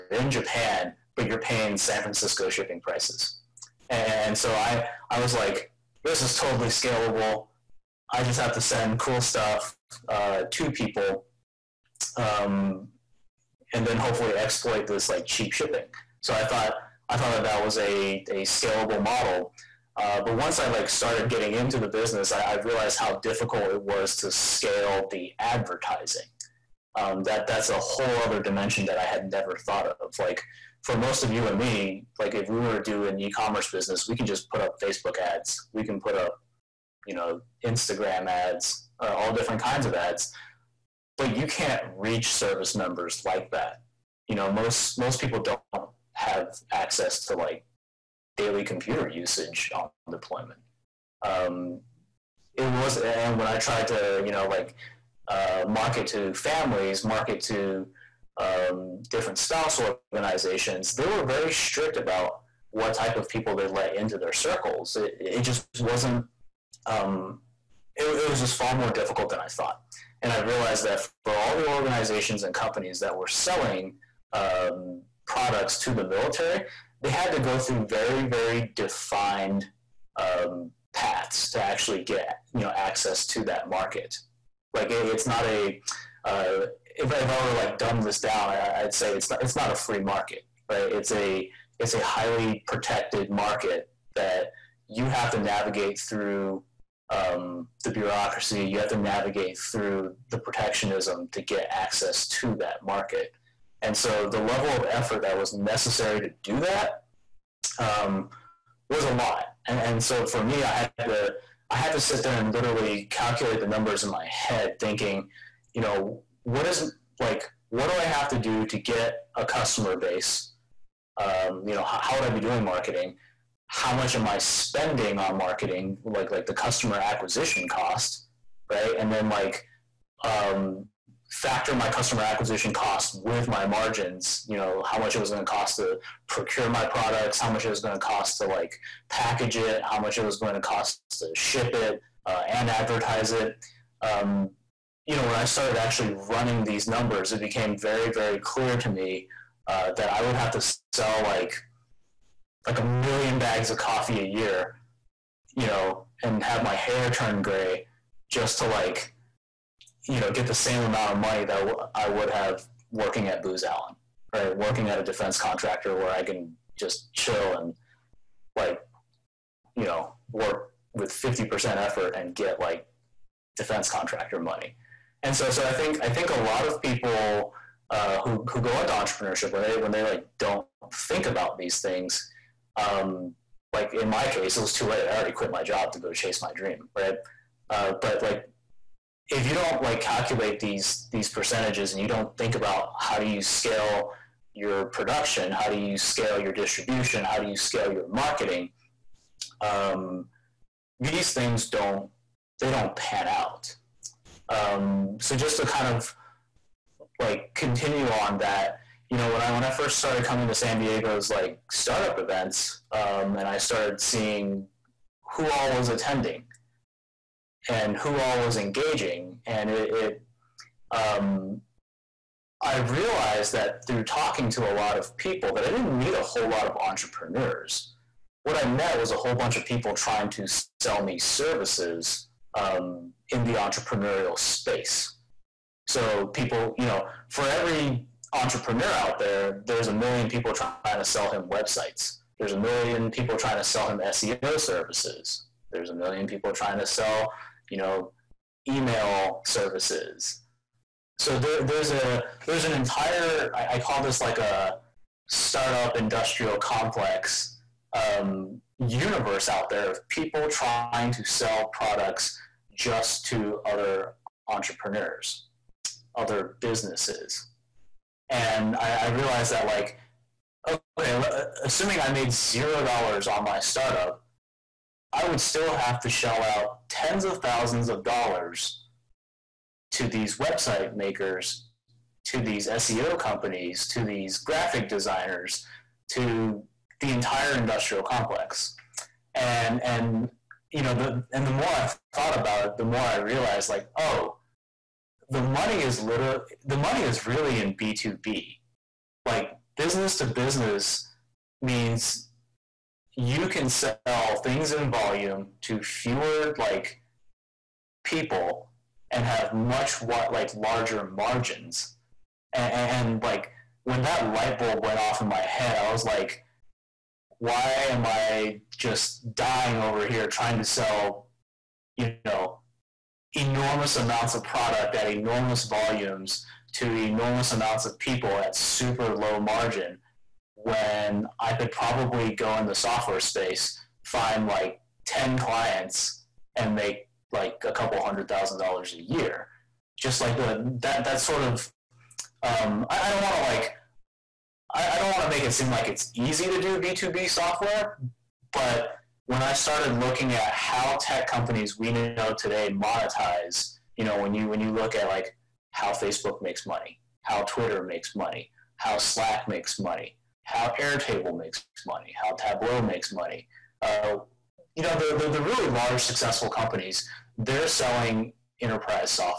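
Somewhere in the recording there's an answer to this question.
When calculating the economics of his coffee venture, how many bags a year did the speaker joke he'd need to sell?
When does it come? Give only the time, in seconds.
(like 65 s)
152 s.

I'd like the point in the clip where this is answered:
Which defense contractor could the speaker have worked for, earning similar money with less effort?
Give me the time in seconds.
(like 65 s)
163 s.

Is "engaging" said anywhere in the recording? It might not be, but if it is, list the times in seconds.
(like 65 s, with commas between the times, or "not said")
218 s.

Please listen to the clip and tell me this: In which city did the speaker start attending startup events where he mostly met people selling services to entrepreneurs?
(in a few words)
San Diego.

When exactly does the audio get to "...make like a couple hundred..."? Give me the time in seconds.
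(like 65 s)
336 s.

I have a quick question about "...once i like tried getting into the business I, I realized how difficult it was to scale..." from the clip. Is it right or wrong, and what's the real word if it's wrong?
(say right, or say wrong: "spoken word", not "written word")
wrong: "started", not "tried".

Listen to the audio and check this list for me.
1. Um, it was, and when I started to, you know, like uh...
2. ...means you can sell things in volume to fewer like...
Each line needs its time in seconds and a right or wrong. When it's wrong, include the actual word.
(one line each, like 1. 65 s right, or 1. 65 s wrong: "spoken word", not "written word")
1. 51 s wrong: "tried", not "started"
2. 301 s right.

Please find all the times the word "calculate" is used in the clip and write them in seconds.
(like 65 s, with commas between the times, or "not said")
113 s, 190 s.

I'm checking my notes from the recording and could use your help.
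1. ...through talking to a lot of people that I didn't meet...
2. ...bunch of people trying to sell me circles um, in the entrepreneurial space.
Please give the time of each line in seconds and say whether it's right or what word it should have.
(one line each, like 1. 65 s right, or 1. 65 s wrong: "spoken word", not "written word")
1. 223 s right
2. 229 s wrong: "services", not "circles".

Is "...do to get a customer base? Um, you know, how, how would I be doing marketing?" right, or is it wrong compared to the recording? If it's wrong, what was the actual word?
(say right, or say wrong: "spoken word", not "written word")
right.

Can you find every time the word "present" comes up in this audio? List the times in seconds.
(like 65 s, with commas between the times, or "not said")
not said.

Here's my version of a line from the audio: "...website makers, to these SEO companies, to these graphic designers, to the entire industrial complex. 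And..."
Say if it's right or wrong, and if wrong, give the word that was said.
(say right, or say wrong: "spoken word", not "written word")
right.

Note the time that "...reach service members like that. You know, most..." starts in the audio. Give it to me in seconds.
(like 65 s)
41 s.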